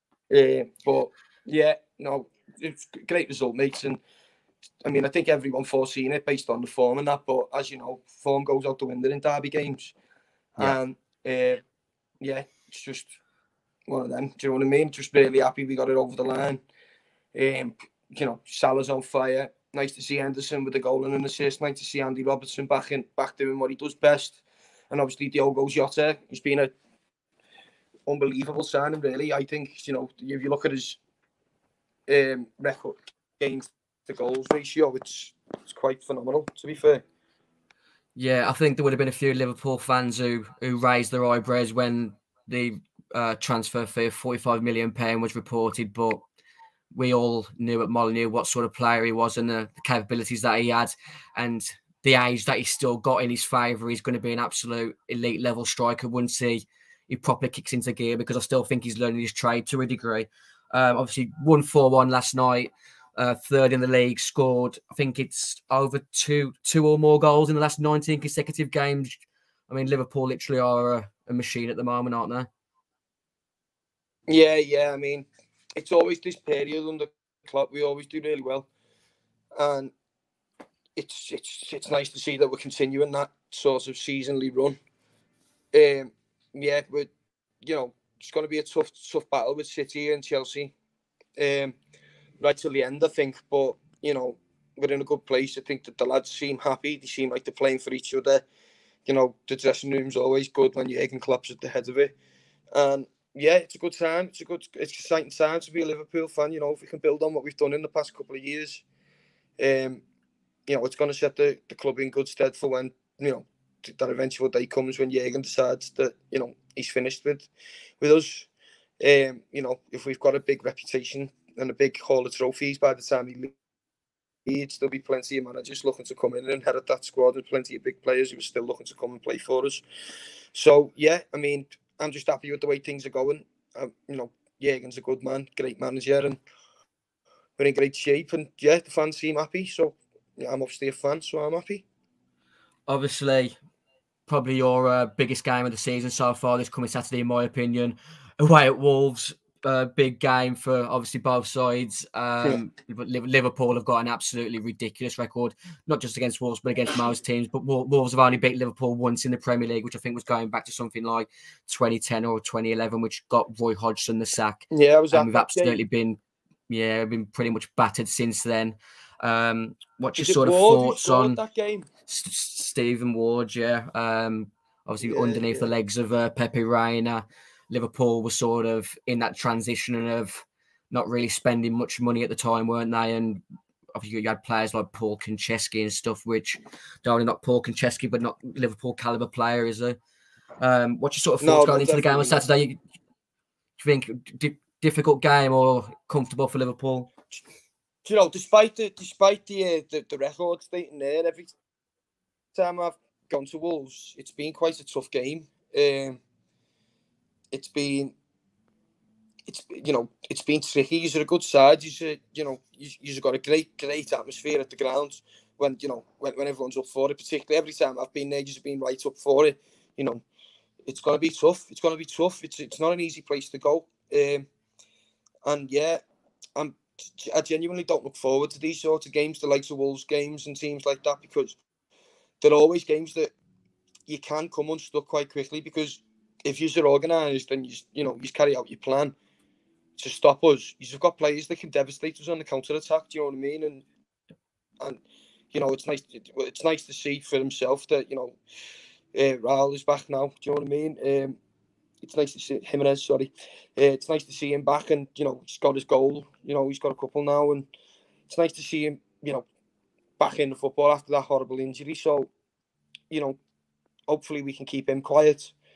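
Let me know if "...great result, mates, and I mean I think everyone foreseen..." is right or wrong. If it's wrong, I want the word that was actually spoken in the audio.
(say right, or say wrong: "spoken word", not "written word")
right.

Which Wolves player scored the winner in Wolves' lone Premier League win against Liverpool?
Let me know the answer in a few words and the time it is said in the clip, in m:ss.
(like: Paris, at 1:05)
Stephen Ward, at 2:52.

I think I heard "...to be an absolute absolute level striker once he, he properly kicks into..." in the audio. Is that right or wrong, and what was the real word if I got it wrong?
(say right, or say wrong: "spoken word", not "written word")
wrong: "elite", not "absolute".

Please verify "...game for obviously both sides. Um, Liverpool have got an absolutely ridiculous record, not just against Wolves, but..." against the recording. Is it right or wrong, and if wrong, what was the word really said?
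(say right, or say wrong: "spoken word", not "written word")
right.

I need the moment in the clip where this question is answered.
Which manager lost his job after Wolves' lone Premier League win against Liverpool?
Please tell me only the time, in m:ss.
2:43.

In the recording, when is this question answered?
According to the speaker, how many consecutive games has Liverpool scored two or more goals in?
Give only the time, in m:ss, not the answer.
1:07.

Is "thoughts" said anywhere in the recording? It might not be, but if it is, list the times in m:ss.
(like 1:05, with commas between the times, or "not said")
2:50, 3:11.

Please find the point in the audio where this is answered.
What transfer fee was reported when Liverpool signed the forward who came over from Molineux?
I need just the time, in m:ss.
0:44.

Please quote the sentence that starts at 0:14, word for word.
Just really happy we got it over the line.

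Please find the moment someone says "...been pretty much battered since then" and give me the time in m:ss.
2:47.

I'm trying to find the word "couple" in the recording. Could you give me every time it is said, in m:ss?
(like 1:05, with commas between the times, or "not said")
1:48, 4:16.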